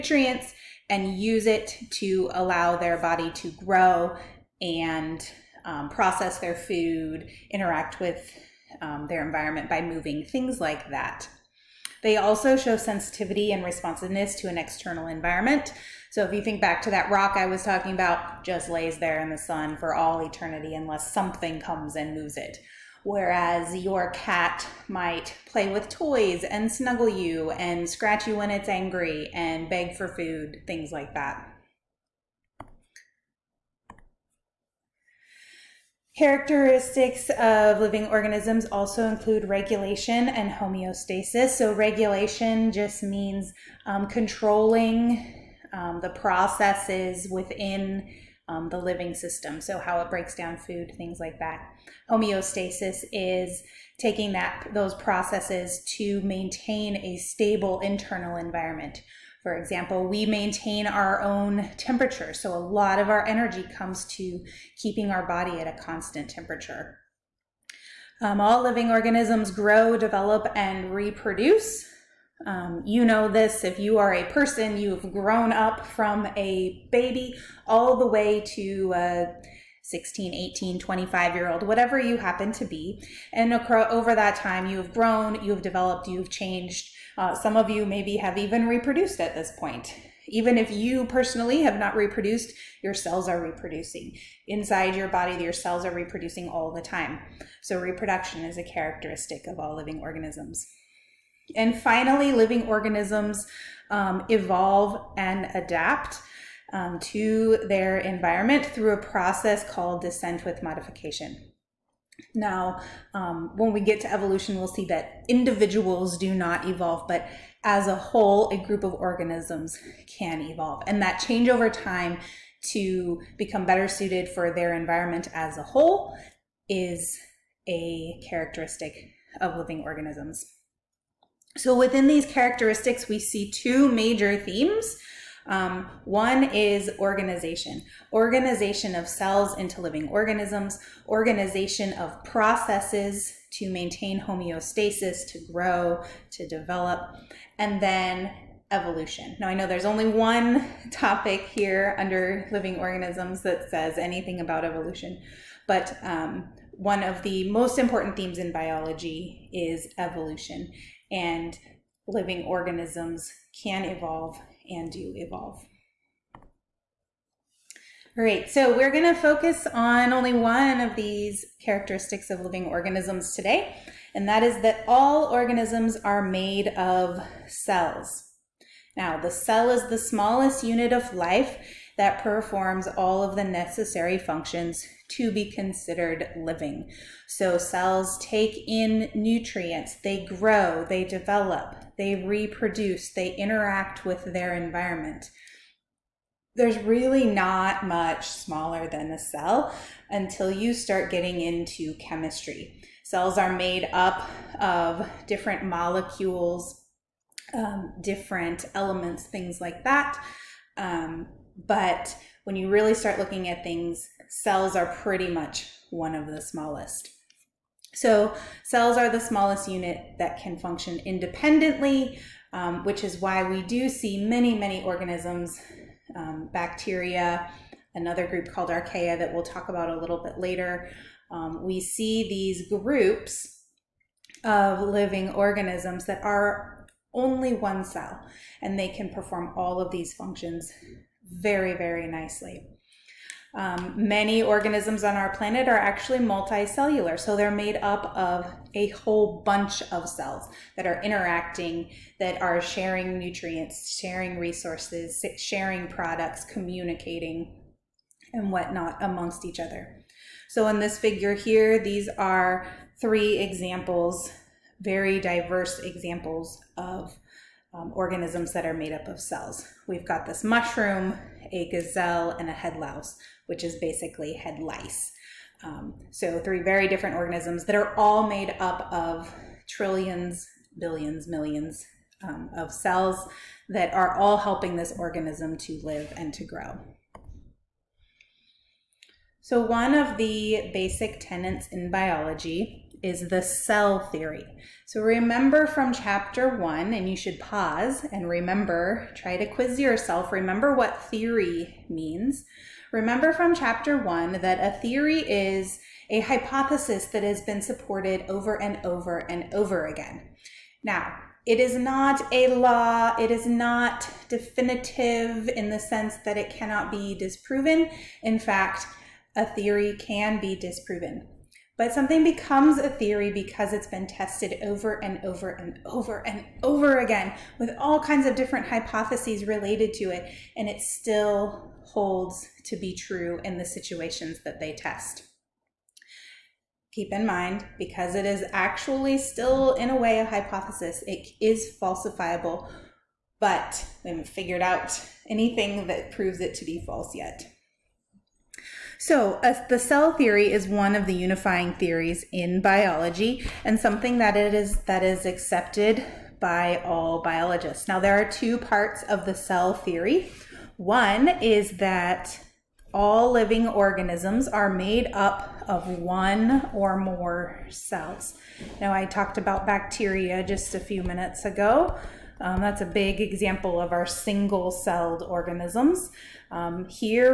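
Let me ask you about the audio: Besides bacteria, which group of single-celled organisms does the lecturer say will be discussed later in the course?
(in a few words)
archaea.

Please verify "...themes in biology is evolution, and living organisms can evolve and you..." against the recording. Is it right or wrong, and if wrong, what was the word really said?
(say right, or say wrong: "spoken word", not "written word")
right.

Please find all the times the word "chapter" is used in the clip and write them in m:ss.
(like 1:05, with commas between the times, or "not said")
4:55, 5:03.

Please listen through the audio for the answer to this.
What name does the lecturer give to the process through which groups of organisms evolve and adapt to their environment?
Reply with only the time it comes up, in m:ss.
1:50.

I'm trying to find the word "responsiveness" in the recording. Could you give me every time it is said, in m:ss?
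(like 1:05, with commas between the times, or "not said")
0:13.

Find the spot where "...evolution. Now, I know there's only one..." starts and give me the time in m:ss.
2:28.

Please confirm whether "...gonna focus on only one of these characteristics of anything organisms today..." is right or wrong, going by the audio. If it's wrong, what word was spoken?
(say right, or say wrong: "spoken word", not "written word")
wrong: "living", not "anything".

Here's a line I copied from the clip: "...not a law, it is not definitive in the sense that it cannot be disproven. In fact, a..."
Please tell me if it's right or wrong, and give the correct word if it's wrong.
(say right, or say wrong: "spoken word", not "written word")
right.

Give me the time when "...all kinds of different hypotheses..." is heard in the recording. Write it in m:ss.
5:27.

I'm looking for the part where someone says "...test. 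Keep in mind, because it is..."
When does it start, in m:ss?
5:34.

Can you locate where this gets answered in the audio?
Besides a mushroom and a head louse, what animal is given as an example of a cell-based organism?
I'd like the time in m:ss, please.
4:31.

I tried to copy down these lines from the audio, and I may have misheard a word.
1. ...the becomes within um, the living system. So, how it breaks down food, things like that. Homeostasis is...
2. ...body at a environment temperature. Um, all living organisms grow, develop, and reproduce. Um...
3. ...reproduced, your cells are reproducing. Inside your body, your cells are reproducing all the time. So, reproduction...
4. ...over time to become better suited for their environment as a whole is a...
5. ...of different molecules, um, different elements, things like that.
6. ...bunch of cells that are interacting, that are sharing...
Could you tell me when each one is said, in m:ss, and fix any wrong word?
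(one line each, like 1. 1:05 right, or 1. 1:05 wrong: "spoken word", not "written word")
1. 0:46 wrong: "processes", not "becomes"
2. 1:05 wrong: "constant", not "environment"
3. 1:31 right
4. 2:01 right
5. 3:24 right
6. 4:09 right.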